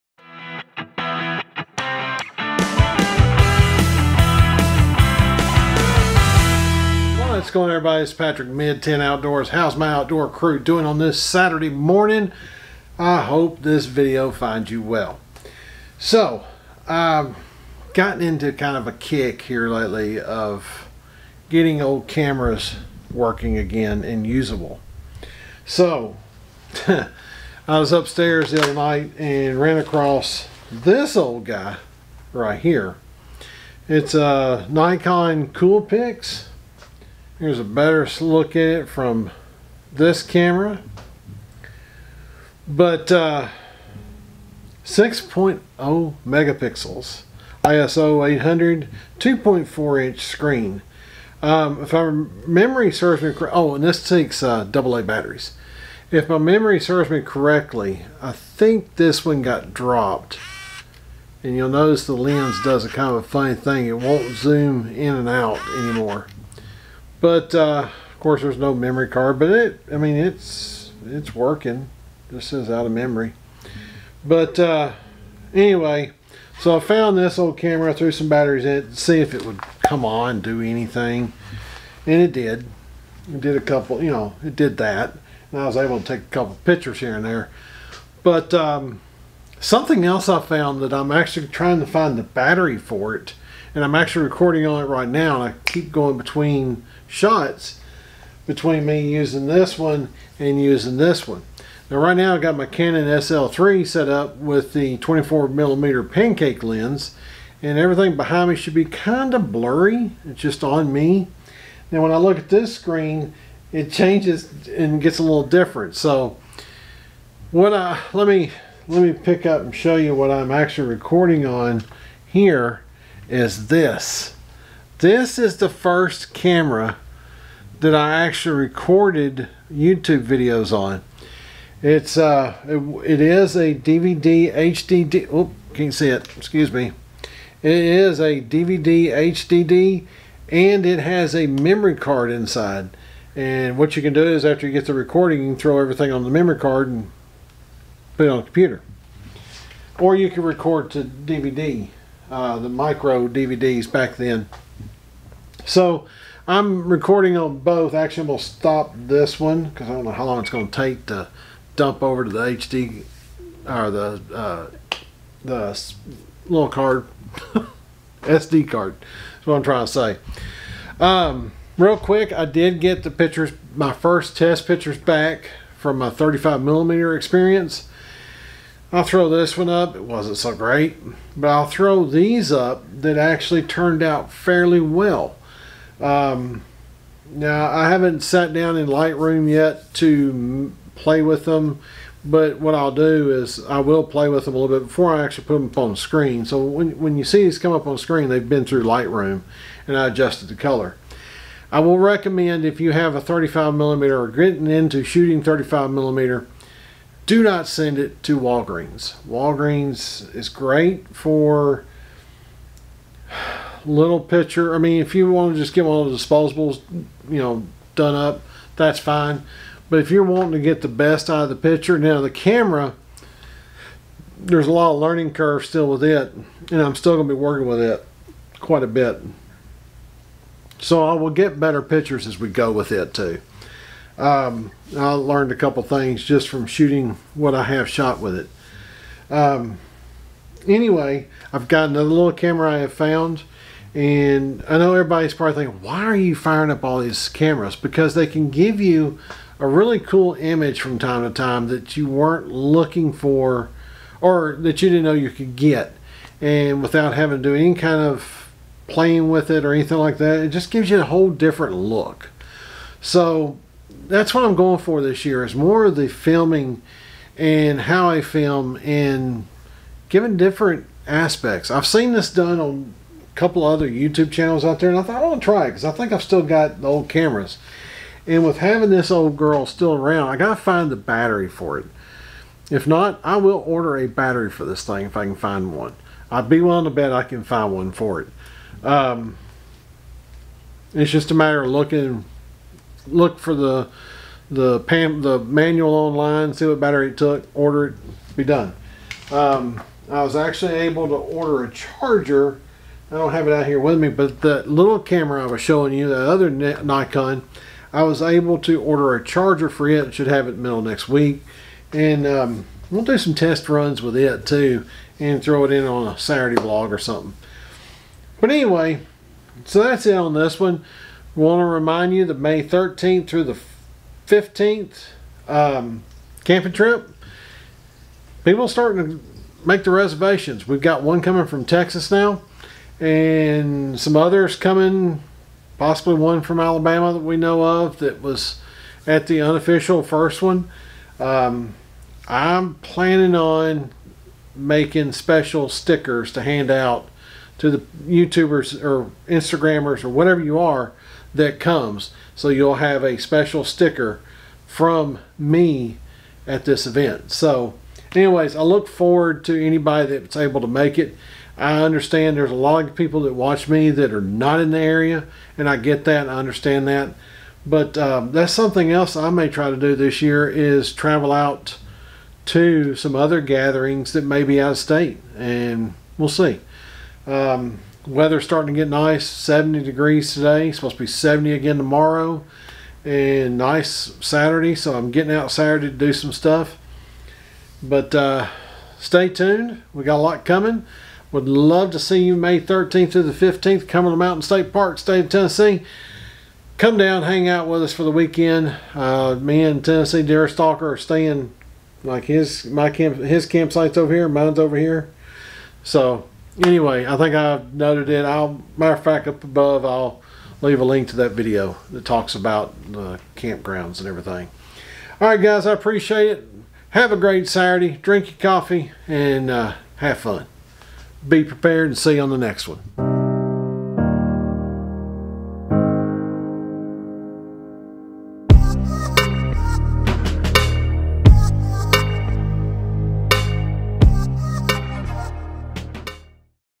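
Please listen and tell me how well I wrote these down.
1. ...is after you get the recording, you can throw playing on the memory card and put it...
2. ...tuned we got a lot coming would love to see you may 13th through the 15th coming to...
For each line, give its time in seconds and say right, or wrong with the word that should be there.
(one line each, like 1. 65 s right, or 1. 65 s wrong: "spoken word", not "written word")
1. 144 s wrong: "everything", not "playing"
2. 389 s right.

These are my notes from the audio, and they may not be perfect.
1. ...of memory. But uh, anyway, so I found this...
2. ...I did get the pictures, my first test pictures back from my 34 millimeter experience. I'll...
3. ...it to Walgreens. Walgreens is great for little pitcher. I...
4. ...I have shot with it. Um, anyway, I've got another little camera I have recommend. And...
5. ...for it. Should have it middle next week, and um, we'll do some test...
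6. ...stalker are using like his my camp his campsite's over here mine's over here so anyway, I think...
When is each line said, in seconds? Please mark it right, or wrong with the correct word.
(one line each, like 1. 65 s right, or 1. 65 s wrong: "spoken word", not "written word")
1. 72 s right
2. 172 s wrong: "35", not "34"
3. 207 s right
4. 237 s wrong: "found", not "recommend"
5. 309 s right
6. 400 s wrong: "staying", not "using".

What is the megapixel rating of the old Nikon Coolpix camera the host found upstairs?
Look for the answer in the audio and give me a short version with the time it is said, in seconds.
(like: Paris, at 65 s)
6.0 megapixels, at 44 s.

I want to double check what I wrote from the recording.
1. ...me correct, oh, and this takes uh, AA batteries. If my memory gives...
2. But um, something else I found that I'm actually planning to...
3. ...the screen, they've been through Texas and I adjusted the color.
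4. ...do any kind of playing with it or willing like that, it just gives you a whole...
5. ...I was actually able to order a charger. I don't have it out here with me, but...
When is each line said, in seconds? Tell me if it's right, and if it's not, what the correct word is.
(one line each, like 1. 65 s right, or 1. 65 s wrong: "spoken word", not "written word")
1. 53 s wrong: "serves", not "gives"
2. 88 s wrong: "trying", not "planning"
3. 197 s wrong: "Lightroom", not "Texas"
4. 257 s wrong: "anything", not "willing"
5. 300 s right.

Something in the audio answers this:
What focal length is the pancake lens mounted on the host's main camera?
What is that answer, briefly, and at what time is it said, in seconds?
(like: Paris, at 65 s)
24 millimeter, at 104 s.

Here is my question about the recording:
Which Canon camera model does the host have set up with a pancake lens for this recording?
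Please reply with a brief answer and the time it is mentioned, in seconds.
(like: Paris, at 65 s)
Canon SL3, at 102 s.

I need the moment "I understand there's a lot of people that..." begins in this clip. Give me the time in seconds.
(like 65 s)
361 s.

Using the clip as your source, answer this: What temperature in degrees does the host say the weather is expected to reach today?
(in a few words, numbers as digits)
70.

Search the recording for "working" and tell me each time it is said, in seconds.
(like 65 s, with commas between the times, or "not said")
23 s, 71 s, 227 s.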